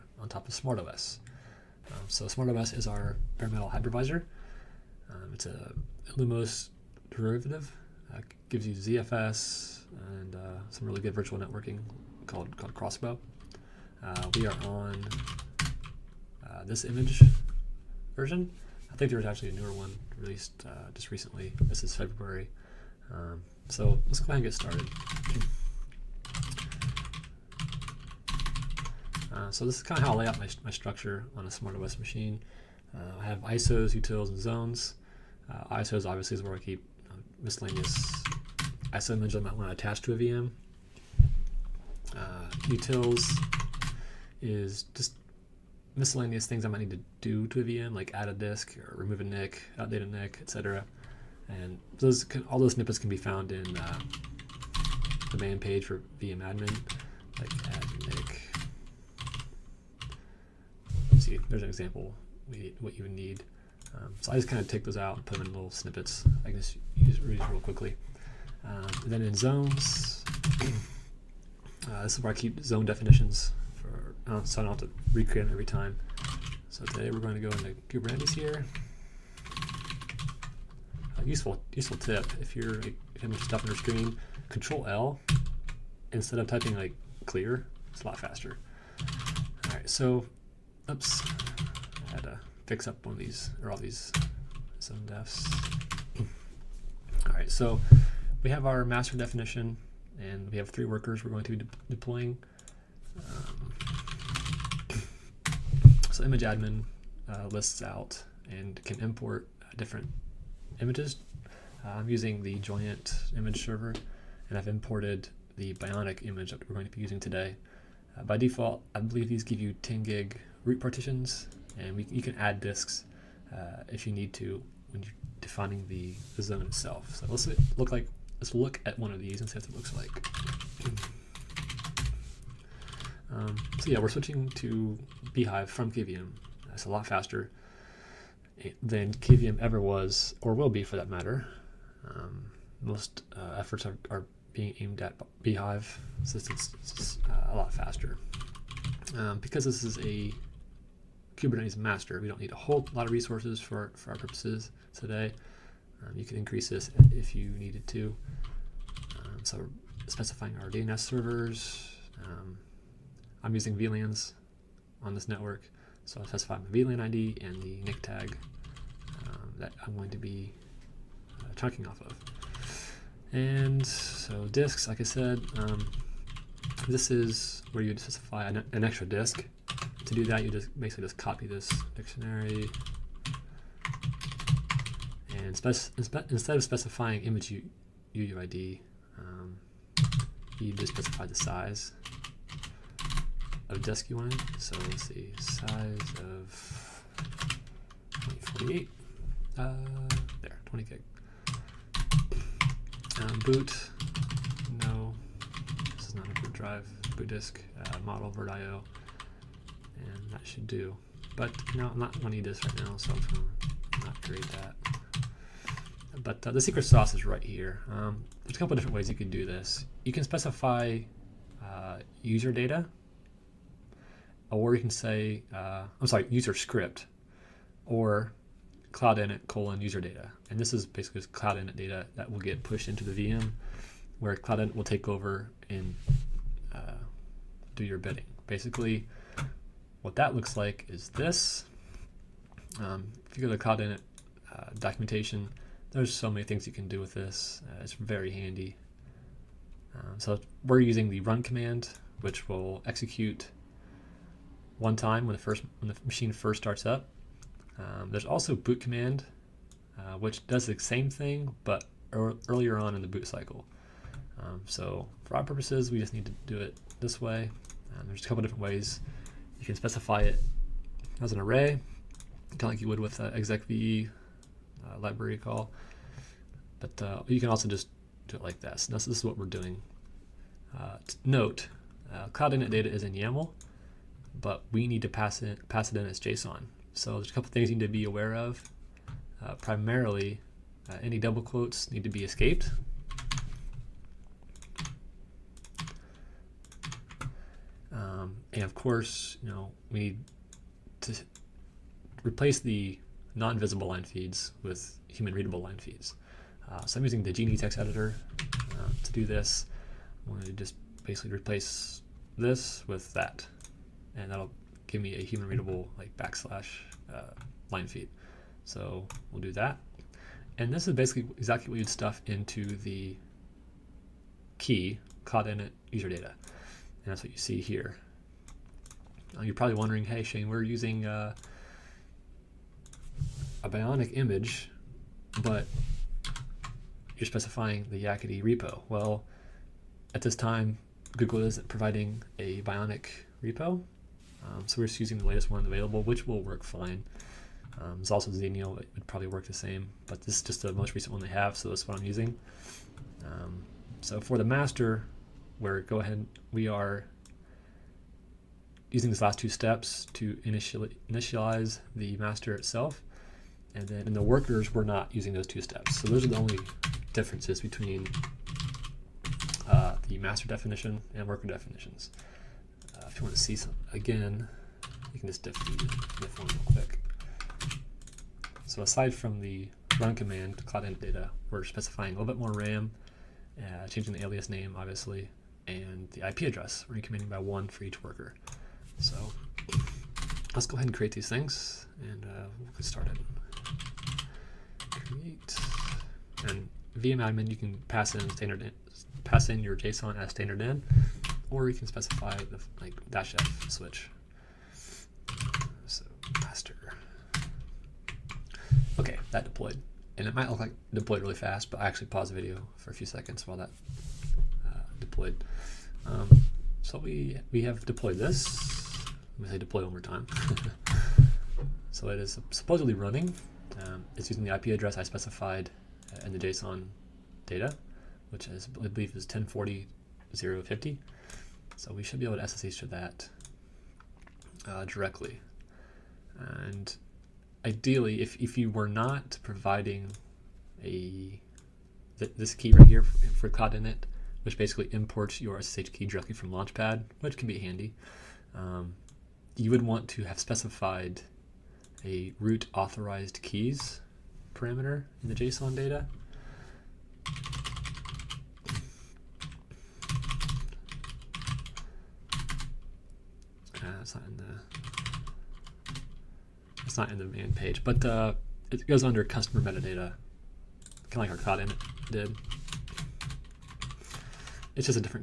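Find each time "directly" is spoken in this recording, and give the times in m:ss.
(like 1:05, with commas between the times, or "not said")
7:14, 7:26.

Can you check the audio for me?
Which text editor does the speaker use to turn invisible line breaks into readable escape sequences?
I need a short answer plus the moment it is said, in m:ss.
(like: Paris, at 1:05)
Geany, at 5:07.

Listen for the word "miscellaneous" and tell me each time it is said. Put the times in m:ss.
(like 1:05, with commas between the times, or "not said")
0:37, 0:45.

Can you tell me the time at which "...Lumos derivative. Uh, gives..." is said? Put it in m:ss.
0:06.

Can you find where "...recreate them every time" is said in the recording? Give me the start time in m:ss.
1:15.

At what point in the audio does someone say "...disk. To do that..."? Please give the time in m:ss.
2:59.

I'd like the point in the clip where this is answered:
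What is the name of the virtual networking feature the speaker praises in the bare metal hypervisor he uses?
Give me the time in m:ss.
0:12.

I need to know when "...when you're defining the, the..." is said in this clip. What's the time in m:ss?
2:04.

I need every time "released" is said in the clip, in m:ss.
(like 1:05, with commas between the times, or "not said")
0:20.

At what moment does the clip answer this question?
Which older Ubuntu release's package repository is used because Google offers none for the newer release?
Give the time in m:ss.
5:38.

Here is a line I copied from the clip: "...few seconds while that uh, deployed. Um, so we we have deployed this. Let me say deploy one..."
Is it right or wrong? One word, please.
right.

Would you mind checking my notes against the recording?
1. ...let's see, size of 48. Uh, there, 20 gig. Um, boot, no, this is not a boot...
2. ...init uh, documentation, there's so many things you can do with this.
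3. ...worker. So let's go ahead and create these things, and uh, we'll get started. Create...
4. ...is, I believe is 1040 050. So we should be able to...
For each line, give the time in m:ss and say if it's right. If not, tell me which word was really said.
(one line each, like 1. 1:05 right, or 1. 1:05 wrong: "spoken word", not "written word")
1. 3:14 right
2. 4:03 right
3. 6:28 right
4. 7:08 right.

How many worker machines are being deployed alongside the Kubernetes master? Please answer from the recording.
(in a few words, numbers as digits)
3.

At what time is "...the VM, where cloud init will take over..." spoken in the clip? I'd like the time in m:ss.
3:53.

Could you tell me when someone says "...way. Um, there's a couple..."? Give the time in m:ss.
4:27.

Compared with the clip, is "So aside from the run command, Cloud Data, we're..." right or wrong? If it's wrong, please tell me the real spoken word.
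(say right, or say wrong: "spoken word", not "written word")
right.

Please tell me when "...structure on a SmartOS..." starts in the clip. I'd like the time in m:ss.
0:30.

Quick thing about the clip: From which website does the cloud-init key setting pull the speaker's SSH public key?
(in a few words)
Launchpad.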